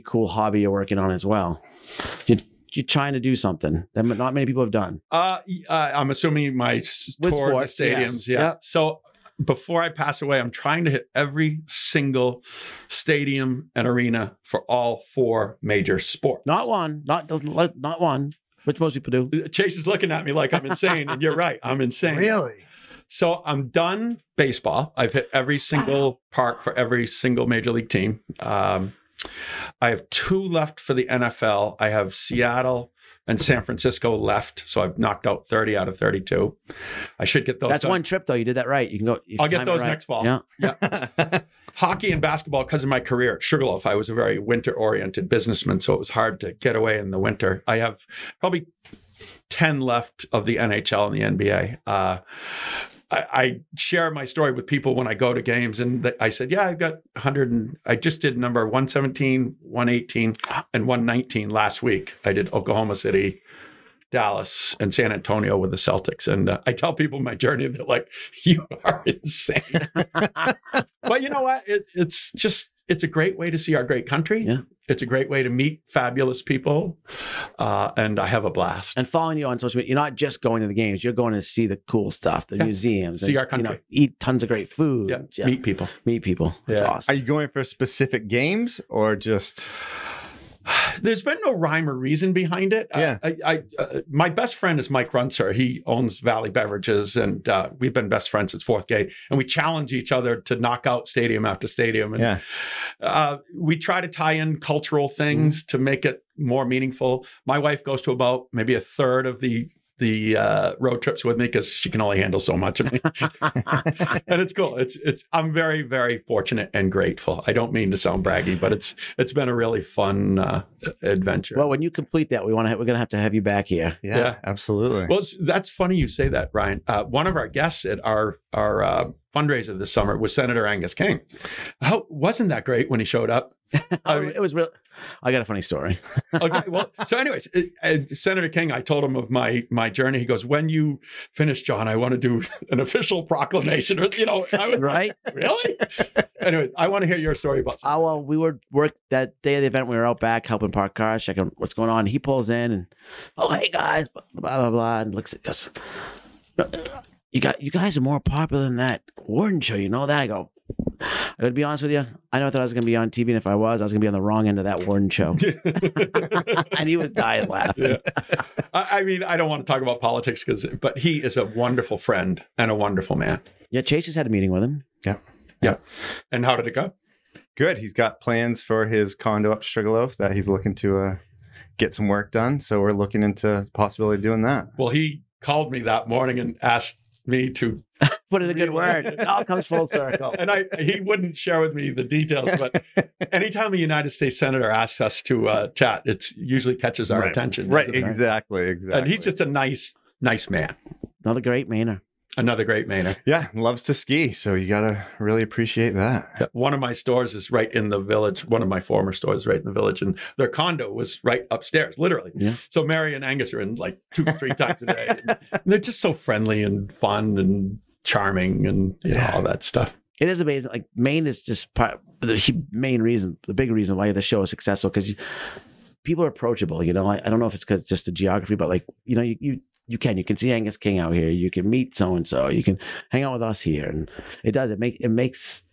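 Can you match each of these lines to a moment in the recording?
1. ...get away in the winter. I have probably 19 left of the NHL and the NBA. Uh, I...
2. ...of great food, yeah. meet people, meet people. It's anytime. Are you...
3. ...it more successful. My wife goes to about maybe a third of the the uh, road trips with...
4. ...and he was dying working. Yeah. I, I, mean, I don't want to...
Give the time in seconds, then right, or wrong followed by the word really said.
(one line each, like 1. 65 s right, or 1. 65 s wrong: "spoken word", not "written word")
1. 46 s wrong: "10", not "19"
2. 84 s wrong: "awesome", not "anytime"
3. 106 s wrong: "meaningful", not "successful"
4. 166 s wrong: "laughing", not "working".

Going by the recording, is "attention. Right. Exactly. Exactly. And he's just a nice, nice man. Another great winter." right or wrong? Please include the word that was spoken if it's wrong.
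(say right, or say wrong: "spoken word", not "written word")
wrong: "manner", not "winter".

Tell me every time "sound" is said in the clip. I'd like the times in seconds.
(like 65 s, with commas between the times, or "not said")
117 s.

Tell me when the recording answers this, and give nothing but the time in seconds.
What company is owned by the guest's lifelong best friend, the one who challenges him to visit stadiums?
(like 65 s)
96 s.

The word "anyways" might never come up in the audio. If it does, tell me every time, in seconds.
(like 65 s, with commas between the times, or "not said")
137 s, 146 s.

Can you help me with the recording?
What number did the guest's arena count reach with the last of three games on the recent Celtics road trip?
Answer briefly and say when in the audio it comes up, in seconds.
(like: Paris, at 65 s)
119, at 60 s.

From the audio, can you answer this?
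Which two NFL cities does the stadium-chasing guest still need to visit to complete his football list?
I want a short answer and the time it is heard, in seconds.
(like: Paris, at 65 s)
Seattle and San Francisco, at 32 s.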